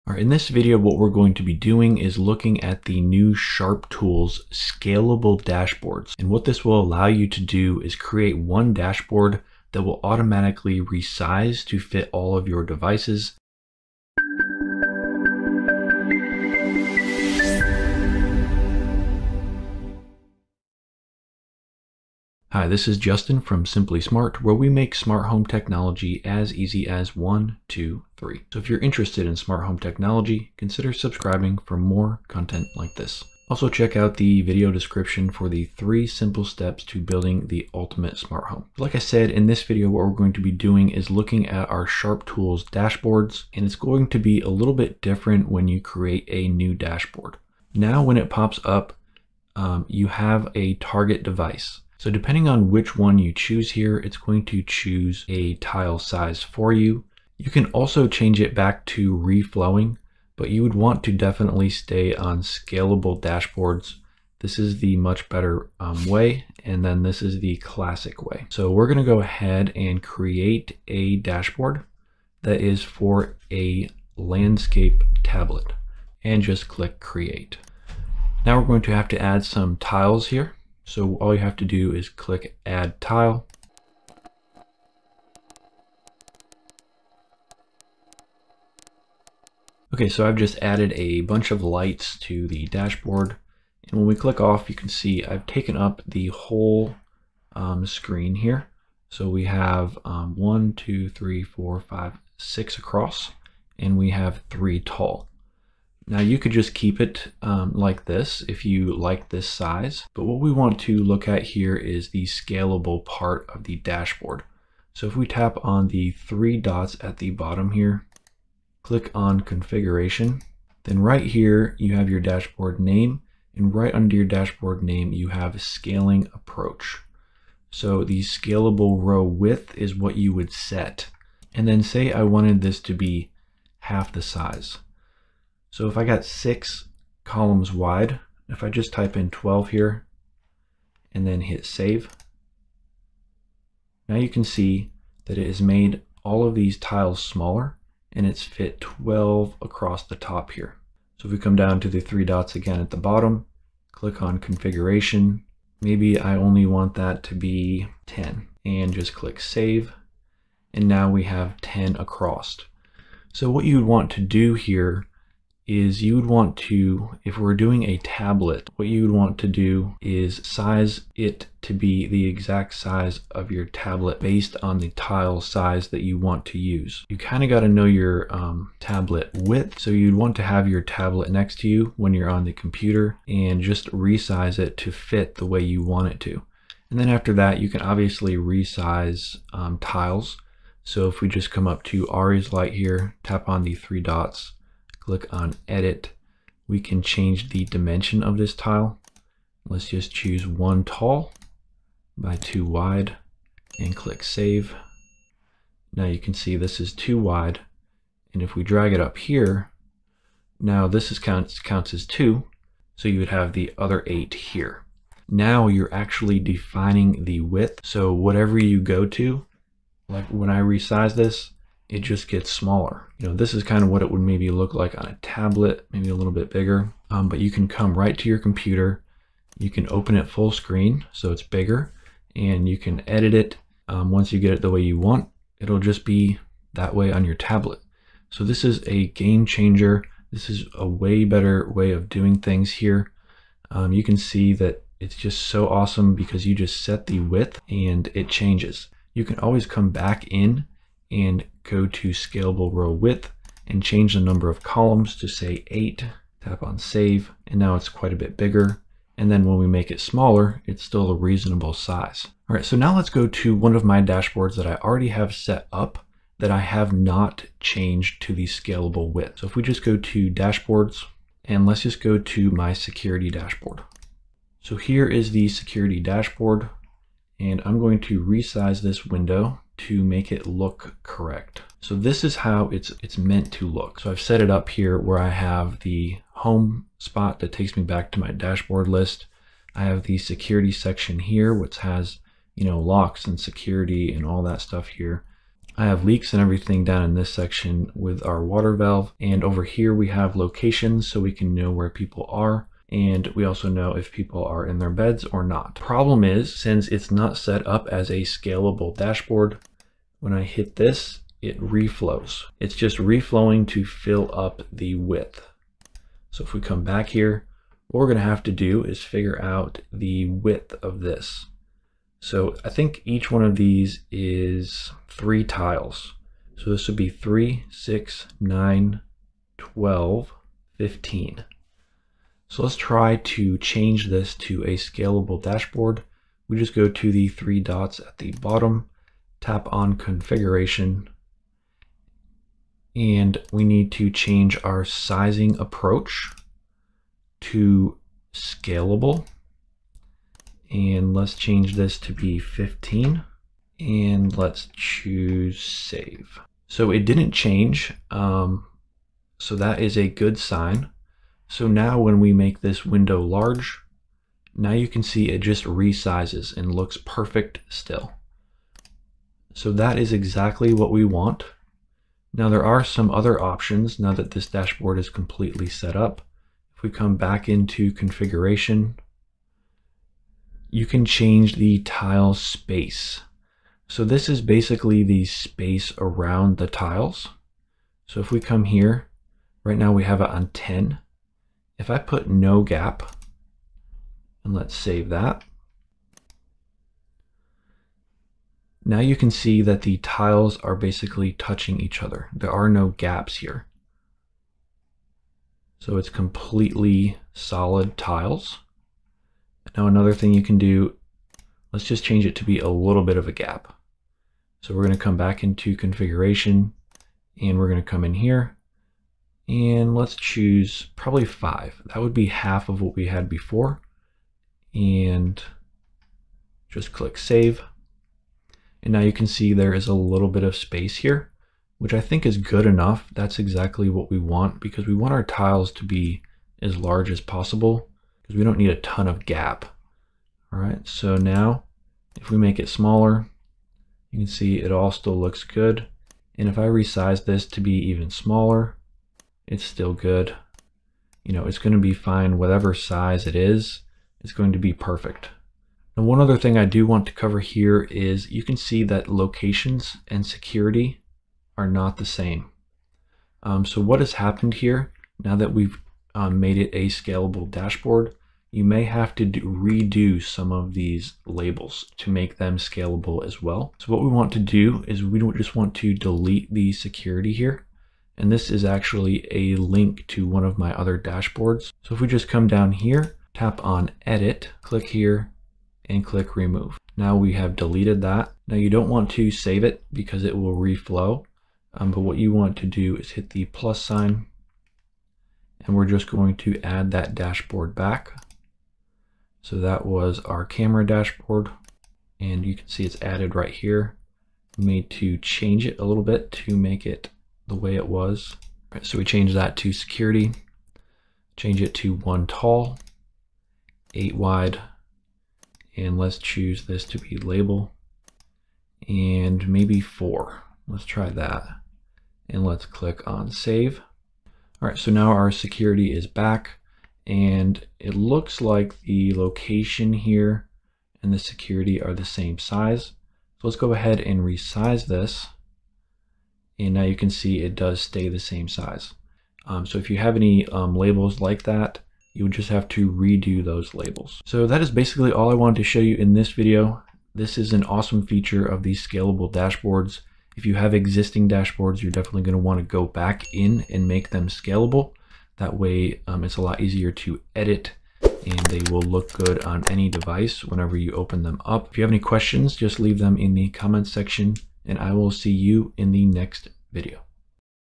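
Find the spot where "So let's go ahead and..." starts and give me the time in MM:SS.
08:53.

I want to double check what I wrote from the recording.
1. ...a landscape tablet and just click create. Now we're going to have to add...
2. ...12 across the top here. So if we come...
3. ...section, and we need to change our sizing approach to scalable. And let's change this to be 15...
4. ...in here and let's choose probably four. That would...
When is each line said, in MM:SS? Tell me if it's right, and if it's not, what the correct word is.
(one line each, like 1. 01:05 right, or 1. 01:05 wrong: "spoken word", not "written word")
1. 01:13 right
2. 02:28 right
3. 05:39 wrong: "configuration", not "section"
4. 06:58 wrong: "five", not "four".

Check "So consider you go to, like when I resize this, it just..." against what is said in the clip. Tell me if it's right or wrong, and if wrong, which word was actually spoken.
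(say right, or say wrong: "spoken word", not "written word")
wrong: "whatever", not "consider".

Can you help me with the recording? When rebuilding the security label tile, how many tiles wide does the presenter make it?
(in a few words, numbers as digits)
8.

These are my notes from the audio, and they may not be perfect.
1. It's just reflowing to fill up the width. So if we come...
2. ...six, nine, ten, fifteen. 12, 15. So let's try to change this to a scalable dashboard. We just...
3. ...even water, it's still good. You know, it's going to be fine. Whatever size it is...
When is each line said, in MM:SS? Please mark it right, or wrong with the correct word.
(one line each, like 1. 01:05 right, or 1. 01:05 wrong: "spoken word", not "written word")
1. 05:12 right
2. 05:27 wrong: "twelve", not "ten"
3. 07:27 wrong: "smaller", not "water".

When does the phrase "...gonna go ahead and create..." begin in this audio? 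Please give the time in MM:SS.
01:08.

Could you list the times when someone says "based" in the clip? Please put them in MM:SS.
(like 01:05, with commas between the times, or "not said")
02:54.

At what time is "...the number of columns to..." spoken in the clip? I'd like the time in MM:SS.
04:14.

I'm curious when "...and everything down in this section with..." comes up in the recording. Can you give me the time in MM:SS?
04:56.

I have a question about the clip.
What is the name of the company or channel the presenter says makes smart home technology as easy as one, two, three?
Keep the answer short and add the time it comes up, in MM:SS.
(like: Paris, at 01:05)
Simply Smart, at 00:23.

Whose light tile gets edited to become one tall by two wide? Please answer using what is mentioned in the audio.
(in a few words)
Ari's.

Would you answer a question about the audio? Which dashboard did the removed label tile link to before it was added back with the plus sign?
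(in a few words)
camera dashboard.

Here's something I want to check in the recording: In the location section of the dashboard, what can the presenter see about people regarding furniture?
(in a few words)
in their beds.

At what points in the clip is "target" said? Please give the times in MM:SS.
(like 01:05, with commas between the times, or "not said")
00:50.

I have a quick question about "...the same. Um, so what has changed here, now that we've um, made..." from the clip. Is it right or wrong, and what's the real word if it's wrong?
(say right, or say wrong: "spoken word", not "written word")
wrong: "happened", not "changed".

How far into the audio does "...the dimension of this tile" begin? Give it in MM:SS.
03:17.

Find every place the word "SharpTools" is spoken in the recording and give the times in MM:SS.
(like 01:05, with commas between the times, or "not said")
00:03, 00:41.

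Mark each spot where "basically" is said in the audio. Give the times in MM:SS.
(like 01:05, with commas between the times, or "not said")
06:24, 06:40, 09:04.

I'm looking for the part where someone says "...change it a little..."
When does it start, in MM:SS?
08:25.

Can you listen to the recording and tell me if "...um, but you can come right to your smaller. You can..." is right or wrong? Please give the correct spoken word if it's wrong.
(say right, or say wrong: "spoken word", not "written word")
wrong: "computer", not "smaller".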